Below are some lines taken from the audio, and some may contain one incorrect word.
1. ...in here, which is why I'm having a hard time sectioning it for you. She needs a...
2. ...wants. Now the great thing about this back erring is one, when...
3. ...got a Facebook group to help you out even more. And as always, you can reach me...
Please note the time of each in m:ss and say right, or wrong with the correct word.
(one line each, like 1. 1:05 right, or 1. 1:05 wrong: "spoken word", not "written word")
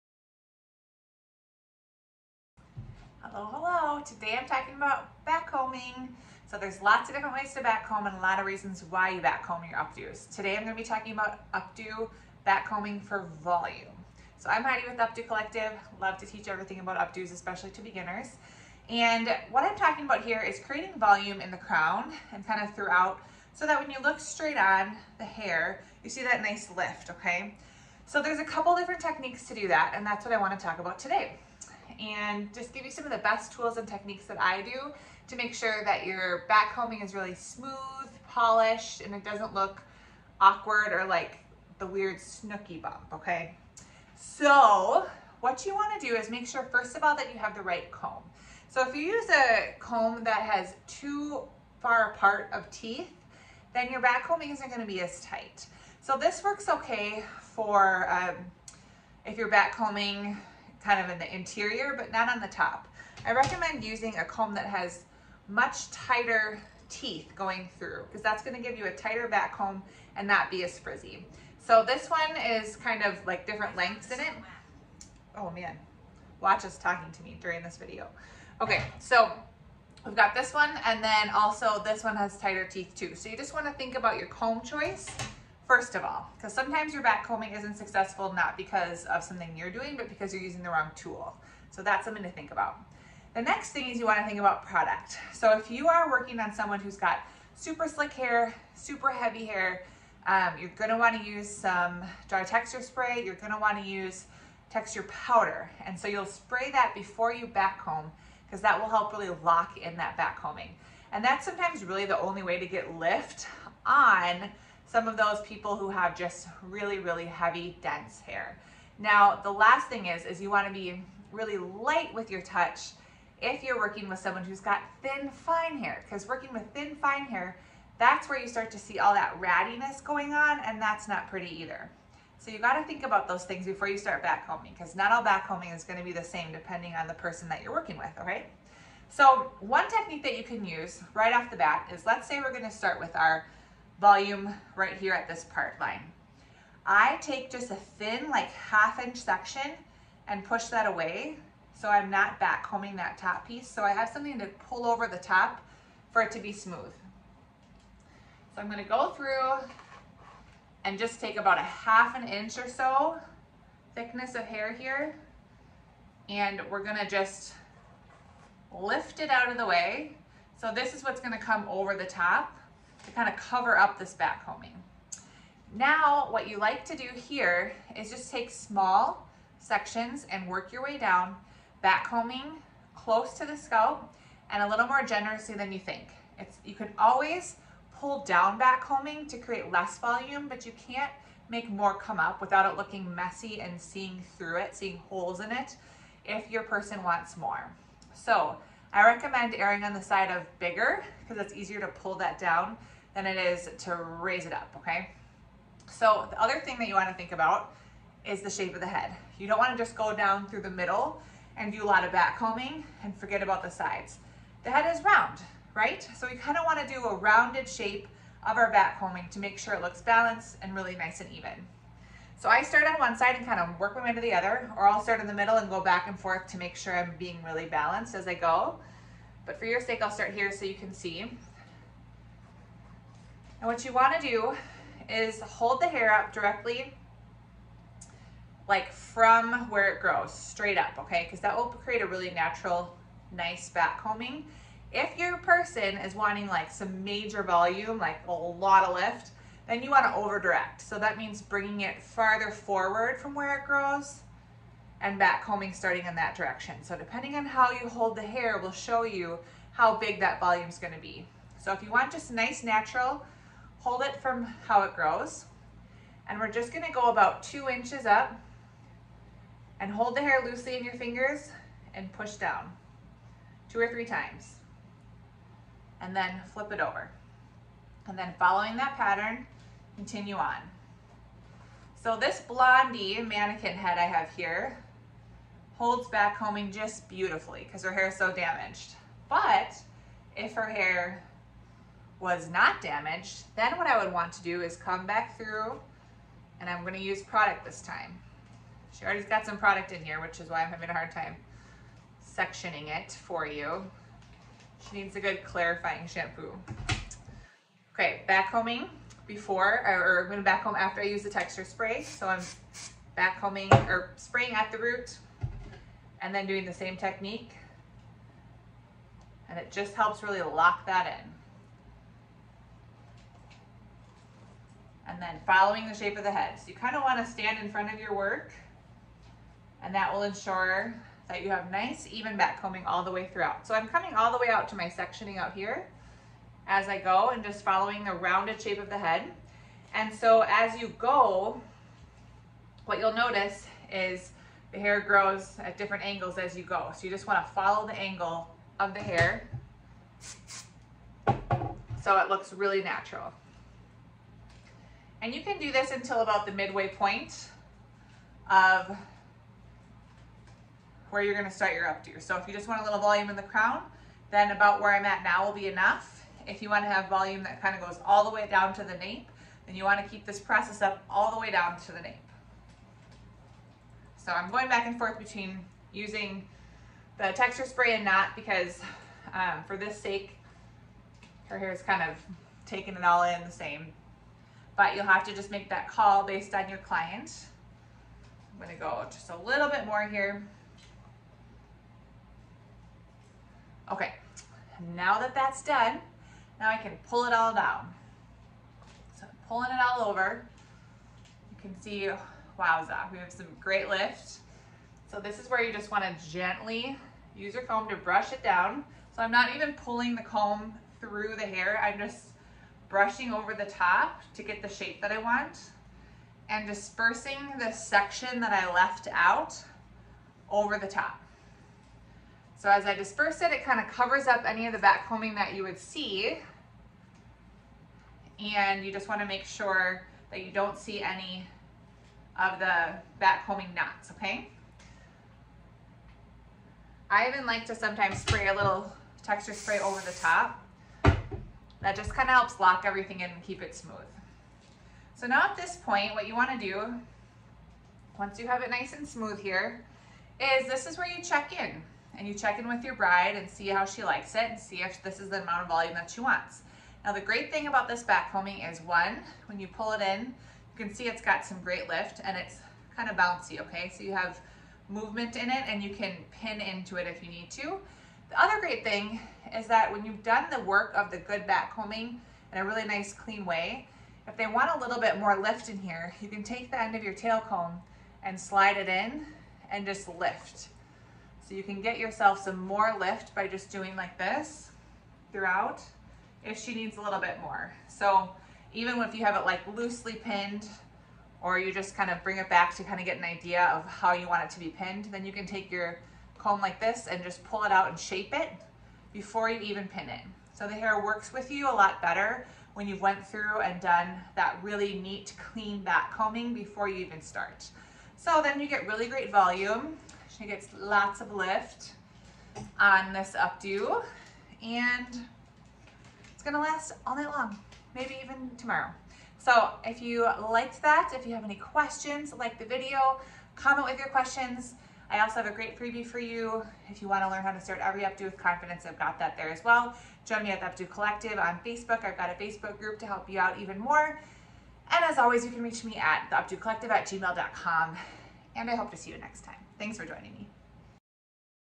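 1. 4:59 right
2. 7:36 wrong: "combing", not "erring"
3. 8:52 right.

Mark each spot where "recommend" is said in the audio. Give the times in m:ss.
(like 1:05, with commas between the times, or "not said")
1:03, 3:19.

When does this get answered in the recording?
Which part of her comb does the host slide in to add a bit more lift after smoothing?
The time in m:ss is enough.
7:56.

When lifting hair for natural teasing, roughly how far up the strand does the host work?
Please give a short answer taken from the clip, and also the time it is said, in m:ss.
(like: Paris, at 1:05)
2 inches, at 4:27.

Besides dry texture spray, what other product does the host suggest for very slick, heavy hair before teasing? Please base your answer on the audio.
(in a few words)
texture powder.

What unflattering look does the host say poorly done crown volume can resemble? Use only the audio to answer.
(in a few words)
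Snooki bump.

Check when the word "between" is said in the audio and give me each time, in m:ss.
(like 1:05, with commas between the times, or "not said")
6:15.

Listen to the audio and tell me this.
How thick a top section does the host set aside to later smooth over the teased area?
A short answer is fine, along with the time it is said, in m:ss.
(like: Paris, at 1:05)
half inch, at 2:28.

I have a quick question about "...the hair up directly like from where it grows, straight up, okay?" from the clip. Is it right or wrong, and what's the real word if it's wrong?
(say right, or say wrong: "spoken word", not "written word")
right.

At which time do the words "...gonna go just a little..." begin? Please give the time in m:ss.
6:28.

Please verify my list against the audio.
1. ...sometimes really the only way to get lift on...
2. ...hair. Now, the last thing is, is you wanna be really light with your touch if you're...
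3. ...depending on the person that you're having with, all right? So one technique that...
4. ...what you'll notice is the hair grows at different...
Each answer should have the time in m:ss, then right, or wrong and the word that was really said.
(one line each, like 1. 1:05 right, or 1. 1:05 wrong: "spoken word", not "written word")
1. 1:51 right
2. 1:58 right
3. 2:16 wrong: "working", not "having"
4. 5:42 right.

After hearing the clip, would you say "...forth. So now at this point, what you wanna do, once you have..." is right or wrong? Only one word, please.
wrong.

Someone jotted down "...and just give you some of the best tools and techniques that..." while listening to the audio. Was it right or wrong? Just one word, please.
right.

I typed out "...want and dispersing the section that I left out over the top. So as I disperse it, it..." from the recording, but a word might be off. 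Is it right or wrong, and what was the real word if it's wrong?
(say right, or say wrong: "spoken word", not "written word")
right.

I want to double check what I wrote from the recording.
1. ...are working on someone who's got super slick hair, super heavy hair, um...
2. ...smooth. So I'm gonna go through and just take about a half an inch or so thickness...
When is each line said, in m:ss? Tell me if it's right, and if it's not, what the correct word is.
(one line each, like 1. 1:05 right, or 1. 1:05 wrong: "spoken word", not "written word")
1. 1:35 right
2. 2:36 right.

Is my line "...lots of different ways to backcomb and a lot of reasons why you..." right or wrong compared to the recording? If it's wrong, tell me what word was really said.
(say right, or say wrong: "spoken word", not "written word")
right.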